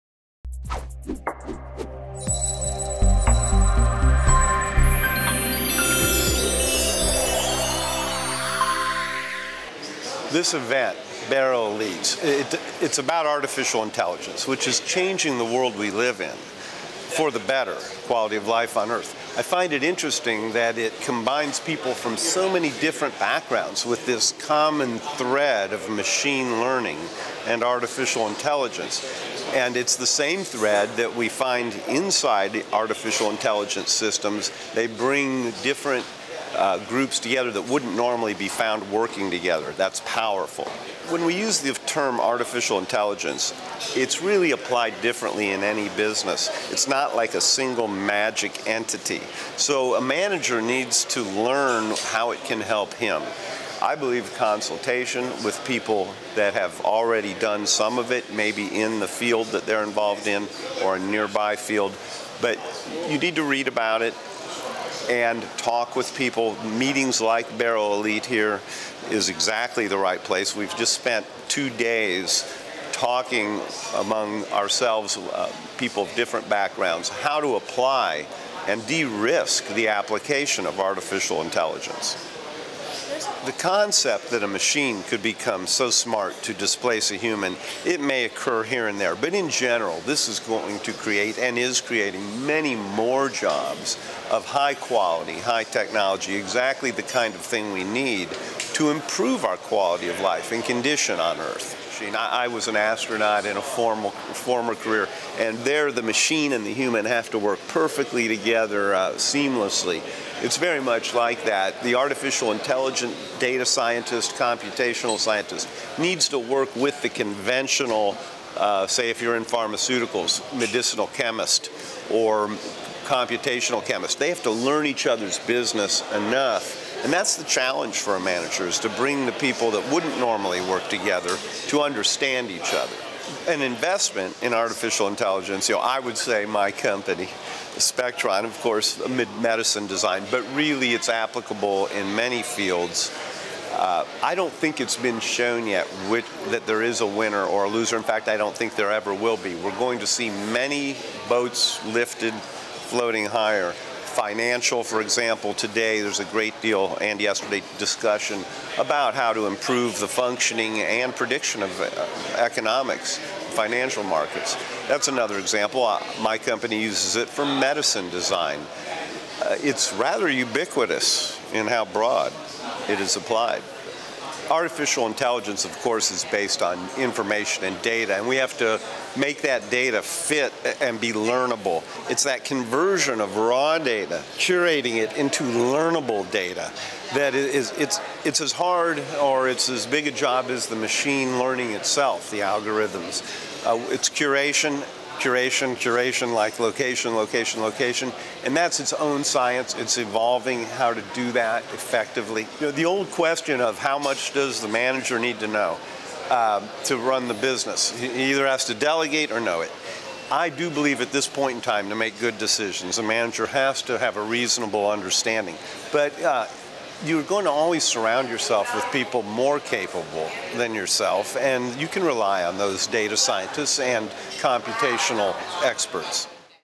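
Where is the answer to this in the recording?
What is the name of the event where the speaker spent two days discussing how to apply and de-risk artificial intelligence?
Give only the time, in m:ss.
0:11.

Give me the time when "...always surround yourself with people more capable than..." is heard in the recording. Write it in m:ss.
3:37.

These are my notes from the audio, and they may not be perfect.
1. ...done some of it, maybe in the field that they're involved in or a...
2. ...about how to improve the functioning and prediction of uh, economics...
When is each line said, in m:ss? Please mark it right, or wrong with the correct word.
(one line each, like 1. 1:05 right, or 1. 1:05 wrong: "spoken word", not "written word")
1. 0:57 right
2. 2:38 right.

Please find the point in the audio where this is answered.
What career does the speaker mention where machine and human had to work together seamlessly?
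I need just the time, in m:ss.
1:42.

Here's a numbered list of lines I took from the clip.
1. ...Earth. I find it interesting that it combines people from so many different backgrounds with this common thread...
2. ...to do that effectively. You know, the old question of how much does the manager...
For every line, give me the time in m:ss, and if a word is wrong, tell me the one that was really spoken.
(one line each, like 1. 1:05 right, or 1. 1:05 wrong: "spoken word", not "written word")
1. 0:18 right
2. 3:20 right.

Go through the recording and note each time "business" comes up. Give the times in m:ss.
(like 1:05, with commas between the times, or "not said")
0:45, 2:05, 3:27.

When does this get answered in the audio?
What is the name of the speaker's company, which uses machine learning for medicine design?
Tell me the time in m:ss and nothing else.
2:17.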